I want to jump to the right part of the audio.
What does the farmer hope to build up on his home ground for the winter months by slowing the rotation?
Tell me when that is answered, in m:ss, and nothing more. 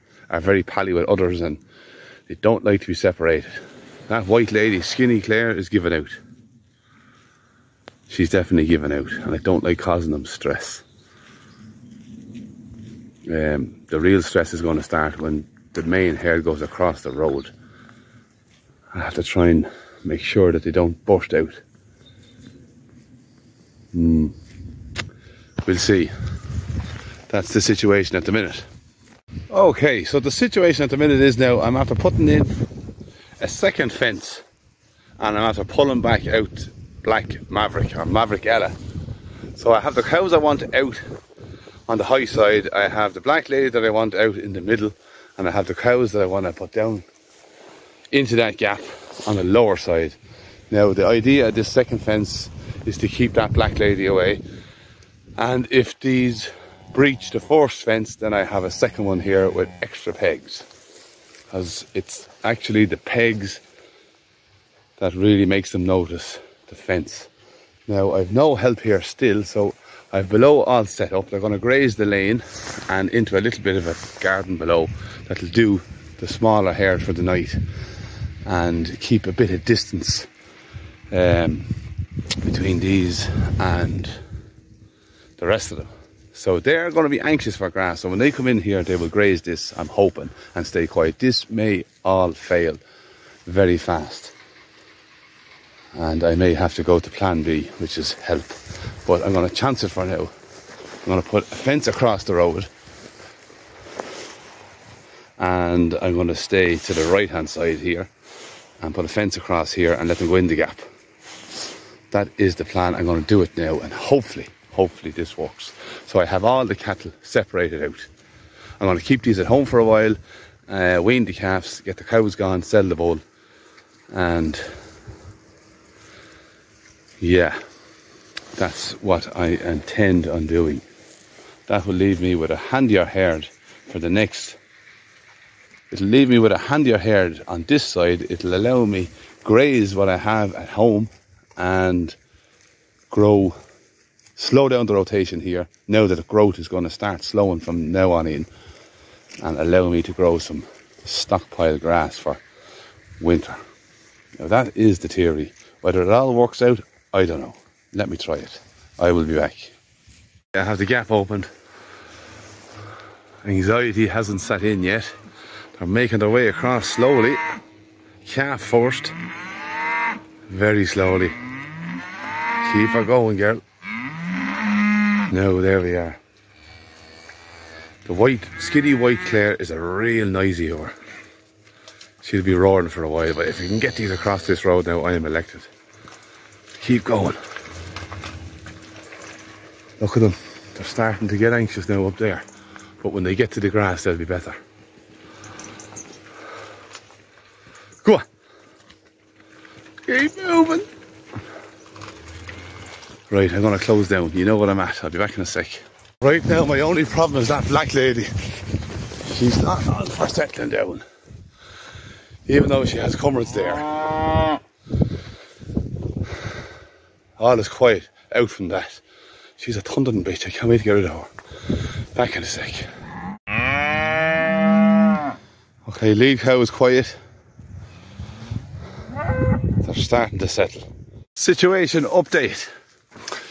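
2:31.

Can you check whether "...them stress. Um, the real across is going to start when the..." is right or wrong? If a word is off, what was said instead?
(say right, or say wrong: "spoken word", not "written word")
wrong: "stress", not "across".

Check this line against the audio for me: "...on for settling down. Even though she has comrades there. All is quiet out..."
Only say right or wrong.
right.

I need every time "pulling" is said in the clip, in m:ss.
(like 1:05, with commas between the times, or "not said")
0:35.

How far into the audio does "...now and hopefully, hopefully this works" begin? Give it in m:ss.
1:53.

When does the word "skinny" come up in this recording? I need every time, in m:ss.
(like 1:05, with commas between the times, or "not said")
0:04, 2:58.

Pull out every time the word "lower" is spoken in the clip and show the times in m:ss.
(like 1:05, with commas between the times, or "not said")
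0:49.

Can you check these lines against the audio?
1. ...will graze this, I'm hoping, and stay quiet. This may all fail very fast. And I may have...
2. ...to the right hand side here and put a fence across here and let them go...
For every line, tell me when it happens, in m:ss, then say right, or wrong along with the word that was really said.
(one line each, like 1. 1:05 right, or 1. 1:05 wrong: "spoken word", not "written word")
1. 1:28 right
2. 1:46 right.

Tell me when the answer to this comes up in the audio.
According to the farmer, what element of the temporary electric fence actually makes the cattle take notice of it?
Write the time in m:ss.
1:02.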